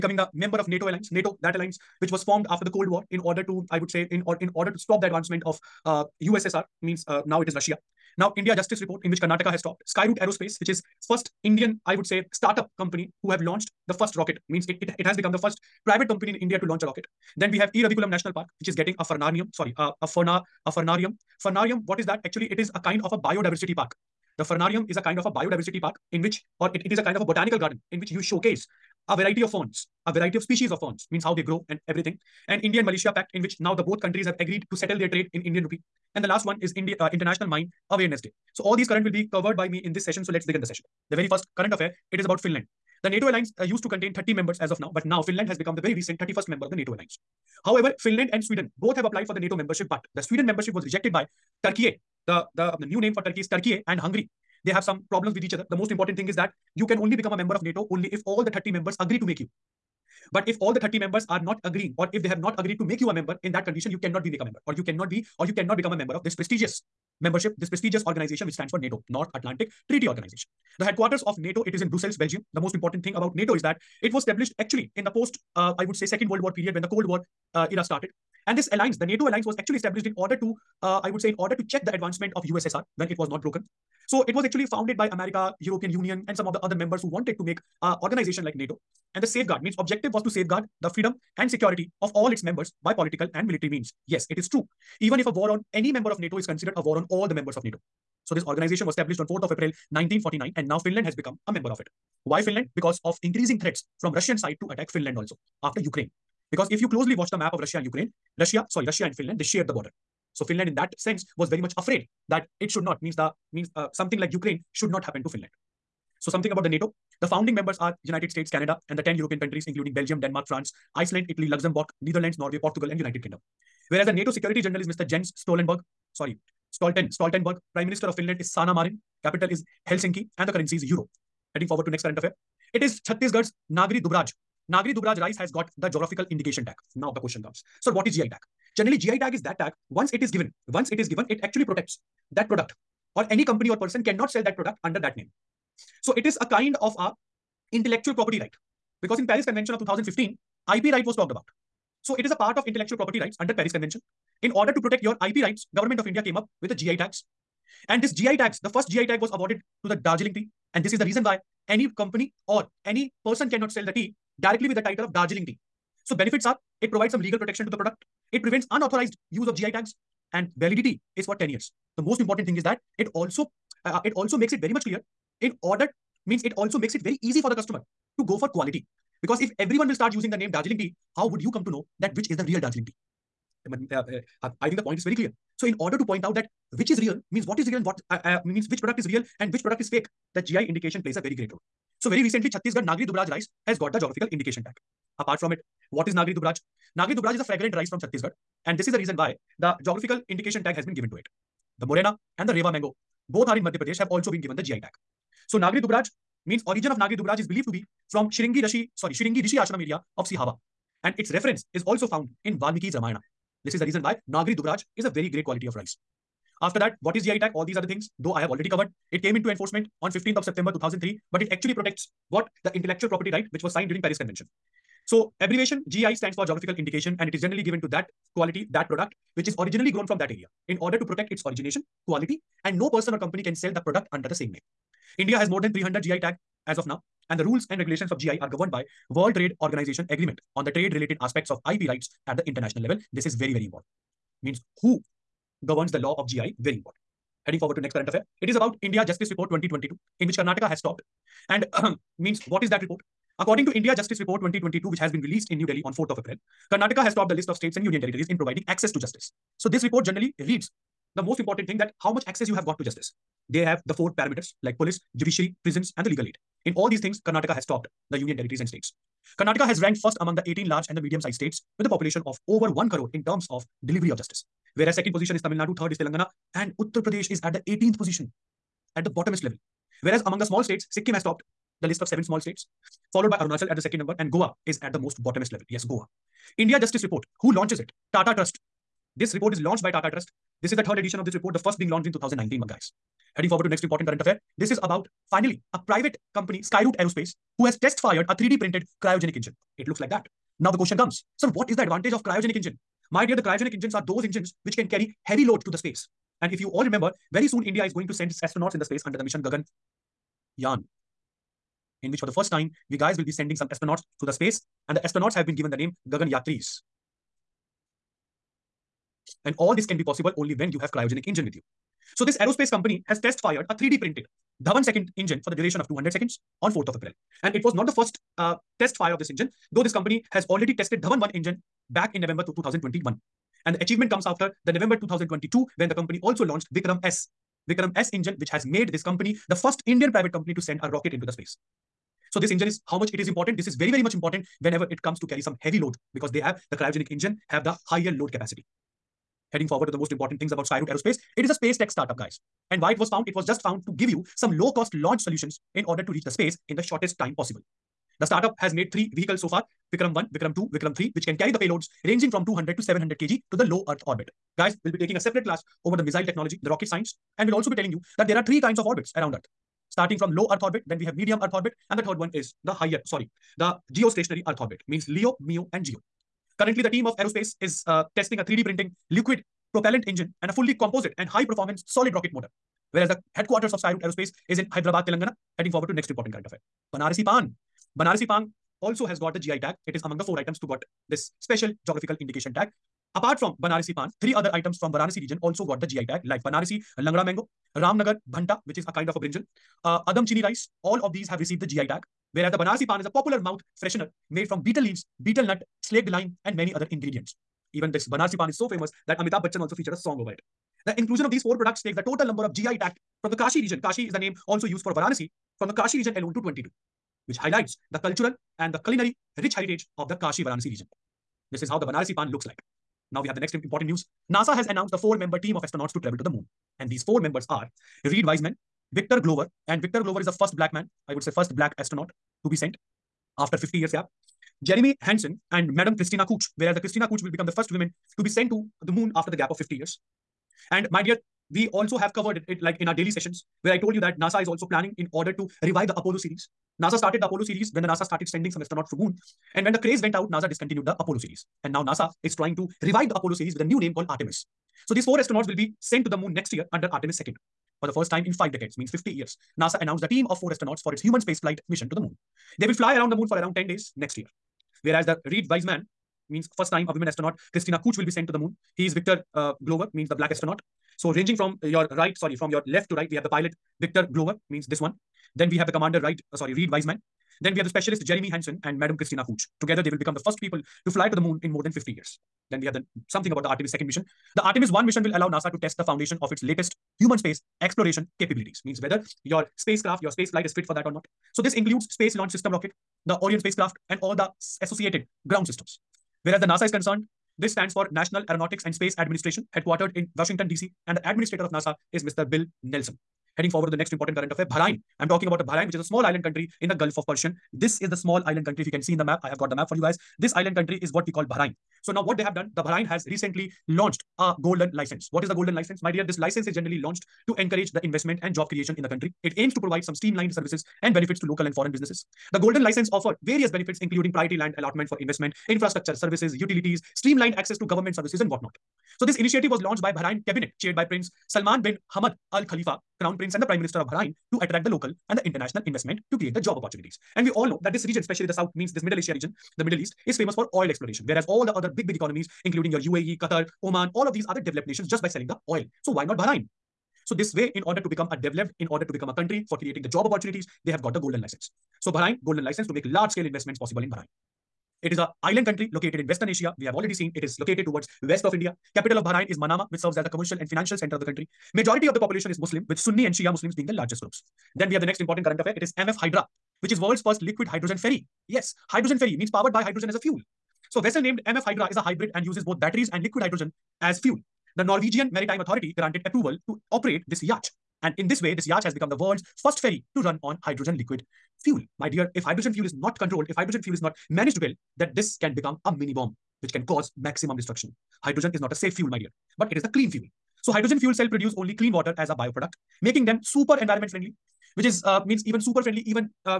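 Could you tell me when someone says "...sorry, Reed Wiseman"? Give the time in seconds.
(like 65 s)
476 s.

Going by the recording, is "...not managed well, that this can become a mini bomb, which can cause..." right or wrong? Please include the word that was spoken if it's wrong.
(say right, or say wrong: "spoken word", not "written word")
right.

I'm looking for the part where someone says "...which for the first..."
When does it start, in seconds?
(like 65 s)
312 s.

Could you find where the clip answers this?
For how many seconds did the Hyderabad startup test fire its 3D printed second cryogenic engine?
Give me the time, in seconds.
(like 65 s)
325 s.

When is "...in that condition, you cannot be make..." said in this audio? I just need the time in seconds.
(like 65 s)
63 s.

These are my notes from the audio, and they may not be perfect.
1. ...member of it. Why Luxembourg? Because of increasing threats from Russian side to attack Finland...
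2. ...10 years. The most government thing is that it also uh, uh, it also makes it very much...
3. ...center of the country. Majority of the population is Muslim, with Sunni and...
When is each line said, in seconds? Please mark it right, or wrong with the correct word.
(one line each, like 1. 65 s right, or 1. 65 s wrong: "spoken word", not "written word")
1. 101 s wrong: "Finland", not "Luxembourg"
2. 171 s wrong: "important", not "government"
3. 560 s right.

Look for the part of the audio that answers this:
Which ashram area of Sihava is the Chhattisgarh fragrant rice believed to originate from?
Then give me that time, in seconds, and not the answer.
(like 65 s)
209 s.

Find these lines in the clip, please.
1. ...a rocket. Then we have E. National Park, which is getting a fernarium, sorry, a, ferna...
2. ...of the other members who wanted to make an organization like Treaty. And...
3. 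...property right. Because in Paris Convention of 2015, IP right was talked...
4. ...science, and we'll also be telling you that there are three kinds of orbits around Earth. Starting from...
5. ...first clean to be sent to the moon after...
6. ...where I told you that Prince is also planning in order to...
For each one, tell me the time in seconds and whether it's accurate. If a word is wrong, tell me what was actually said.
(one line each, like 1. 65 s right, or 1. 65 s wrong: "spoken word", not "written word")
1. 16 s right
2. 86 s wrong: "NATO", not "Treaty"
3. 148 s right
4. 366 s right
5. 437 s wrong: "woman", not "clean"
6. 443 s wrong: "NASA", not "Prince".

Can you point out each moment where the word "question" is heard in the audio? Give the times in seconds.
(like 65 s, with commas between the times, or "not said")
137 s, 300 s.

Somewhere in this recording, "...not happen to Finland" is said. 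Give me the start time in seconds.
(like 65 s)
114 s.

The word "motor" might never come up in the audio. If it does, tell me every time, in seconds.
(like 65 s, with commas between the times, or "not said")
382 s.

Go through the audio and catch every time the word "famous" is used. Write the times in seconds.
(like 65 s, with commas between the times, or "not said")
408 s, 540 s.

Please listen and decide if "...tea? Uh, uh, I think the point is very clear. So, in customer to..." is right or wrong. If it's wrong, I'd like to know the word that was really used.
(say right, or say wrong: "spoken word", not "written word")
wrong: "order", not "customer".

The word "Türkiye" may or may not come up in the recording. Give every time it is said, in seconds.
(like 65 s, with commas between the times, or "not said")
53 s.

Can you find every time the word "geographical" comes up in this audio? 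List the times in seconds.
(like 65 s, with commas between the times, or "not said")
135 s, 193 s, 199 s, 226 s, 391 s.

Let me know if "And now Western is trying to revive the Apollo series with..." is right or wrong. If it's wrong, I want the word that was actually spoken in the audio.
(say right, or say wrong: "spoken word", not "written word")
wrong: "NASA", not "Western".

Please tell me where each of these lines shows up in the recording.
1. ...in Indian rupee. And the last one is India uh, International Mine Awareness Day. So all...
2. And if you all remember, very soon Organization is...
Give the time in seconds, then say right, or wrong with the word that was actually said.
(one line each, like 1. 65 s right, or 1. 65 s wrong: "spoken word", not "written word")
1. 35 s right
2. 306 s wrong: "India", not "Organization".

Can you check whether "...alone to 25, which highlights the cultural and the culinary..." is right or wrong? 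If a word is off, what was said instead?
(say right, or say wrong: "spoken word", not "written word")
wrong: "22", not "25".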